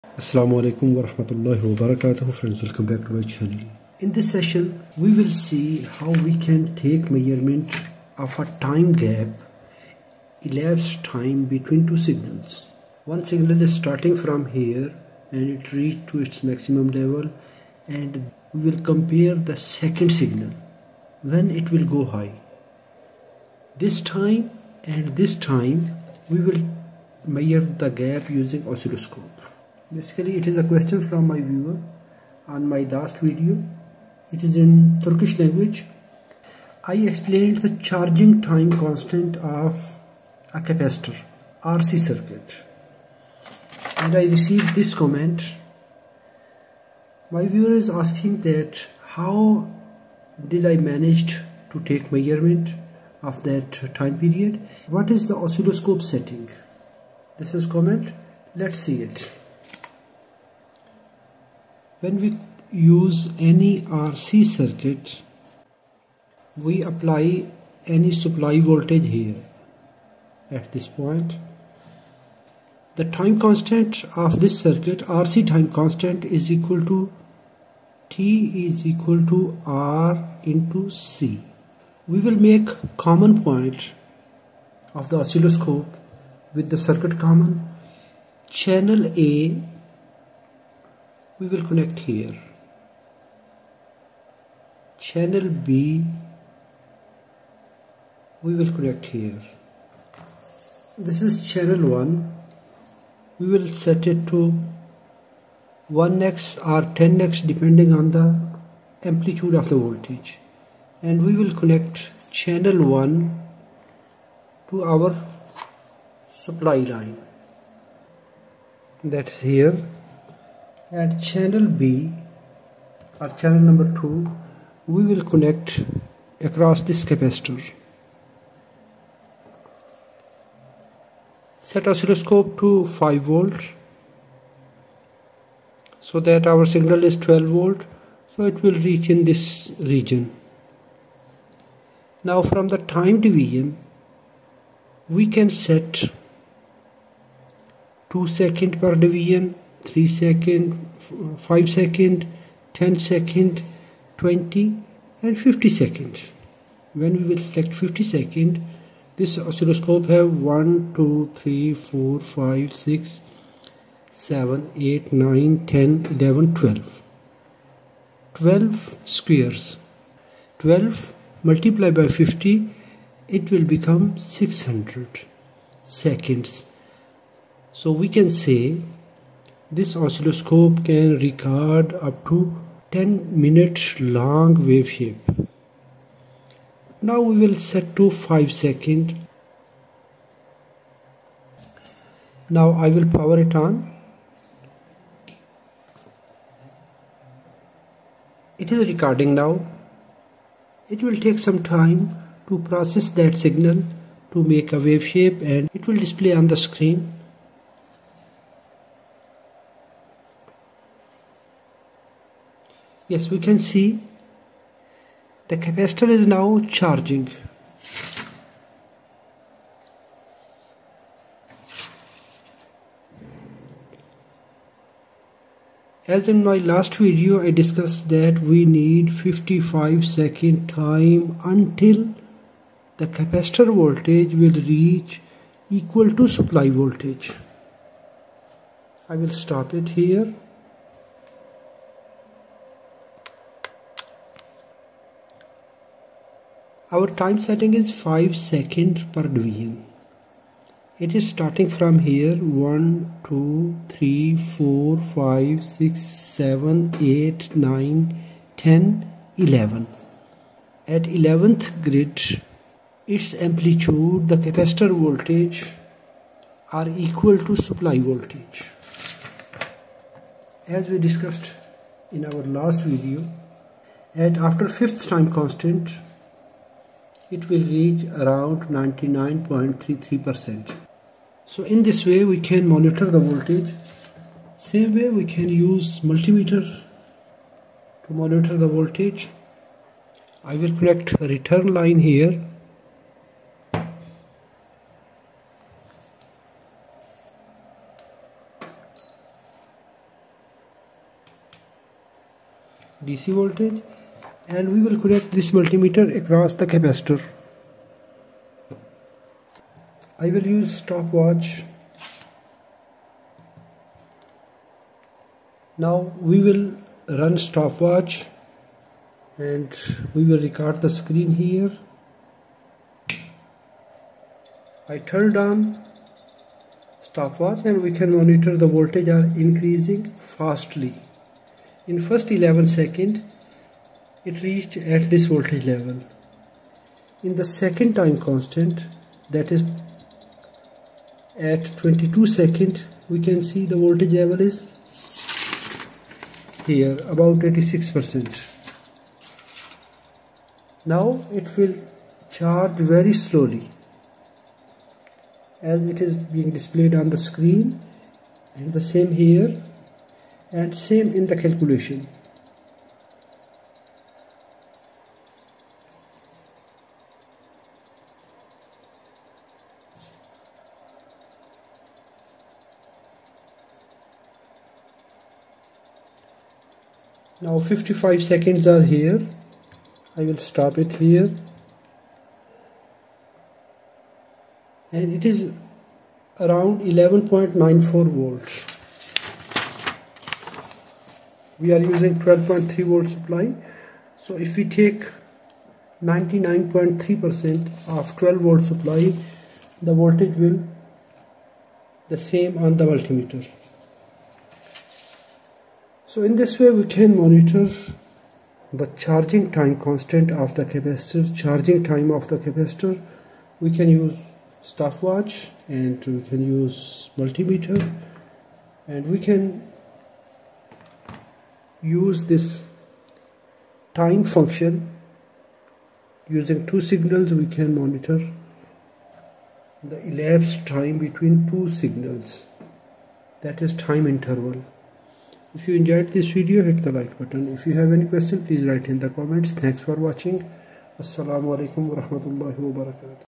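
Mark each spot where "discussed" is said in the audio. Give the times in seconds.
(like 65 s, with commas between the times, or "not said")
227 s, 271 s.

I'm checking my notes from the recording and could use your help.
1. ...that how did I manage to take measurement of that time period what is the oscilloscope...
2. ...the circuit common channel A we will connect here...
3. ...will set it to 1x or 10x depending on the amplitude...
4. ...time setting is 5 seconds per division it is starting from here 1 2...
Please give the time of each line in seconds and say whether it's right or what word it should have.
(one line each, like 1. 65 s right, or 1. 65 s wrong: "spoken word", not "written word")
1. 48 s right
2. 86 s right
3. 103 s right
4. 247 s right.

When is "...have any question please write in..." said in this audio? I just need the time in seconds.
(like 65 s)
437 s.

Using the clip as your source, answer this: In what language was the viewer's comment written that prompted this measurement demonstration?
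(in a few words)
Turkish.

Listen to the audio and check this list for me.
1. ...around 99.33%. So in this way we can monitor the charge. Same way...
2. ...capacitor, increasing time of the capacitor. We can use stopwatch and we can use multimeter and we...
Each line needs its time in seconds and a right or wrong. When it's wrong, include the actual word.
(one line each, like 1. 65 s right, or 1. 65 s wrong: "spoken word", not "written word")
1. 278 s wrong: "voltage", not "charge"
2. 410 s wrong: "charging", not "increasing".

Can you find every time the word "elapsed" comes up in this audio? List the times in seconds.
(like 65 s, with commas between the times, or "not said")
10 s, 430 s.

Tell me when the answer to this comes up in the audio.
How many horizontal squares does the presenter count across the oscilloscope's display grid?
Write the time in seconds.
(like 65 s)
168 s.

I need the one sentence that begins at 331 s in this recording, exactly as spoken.
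In first 11 second it reached at this voltage level.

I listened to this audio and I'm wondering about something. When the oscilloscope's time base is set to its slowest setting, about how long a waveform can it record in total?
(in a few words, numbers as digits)
10 minutes.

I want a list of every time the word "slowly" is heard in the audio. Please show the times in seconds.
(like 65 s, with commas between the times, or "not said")
353 s.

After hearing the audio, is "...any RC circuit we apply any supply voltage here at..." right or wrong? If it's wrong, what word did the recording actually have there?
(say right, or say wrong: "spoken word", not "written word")
right.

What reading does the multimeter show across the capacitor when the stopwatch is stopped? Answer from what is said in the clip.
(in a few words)
11.94 volts.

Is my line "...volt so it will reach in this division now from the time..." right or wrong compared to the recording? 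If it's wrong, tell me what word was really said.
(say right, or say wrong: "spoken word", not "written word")
wrong: "region", not "division".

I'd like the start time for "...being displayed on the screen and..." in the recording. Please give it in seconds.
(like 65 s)
356 s.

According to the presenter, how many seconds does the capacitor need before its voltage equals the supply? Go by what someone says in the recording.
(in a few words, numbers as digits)
55.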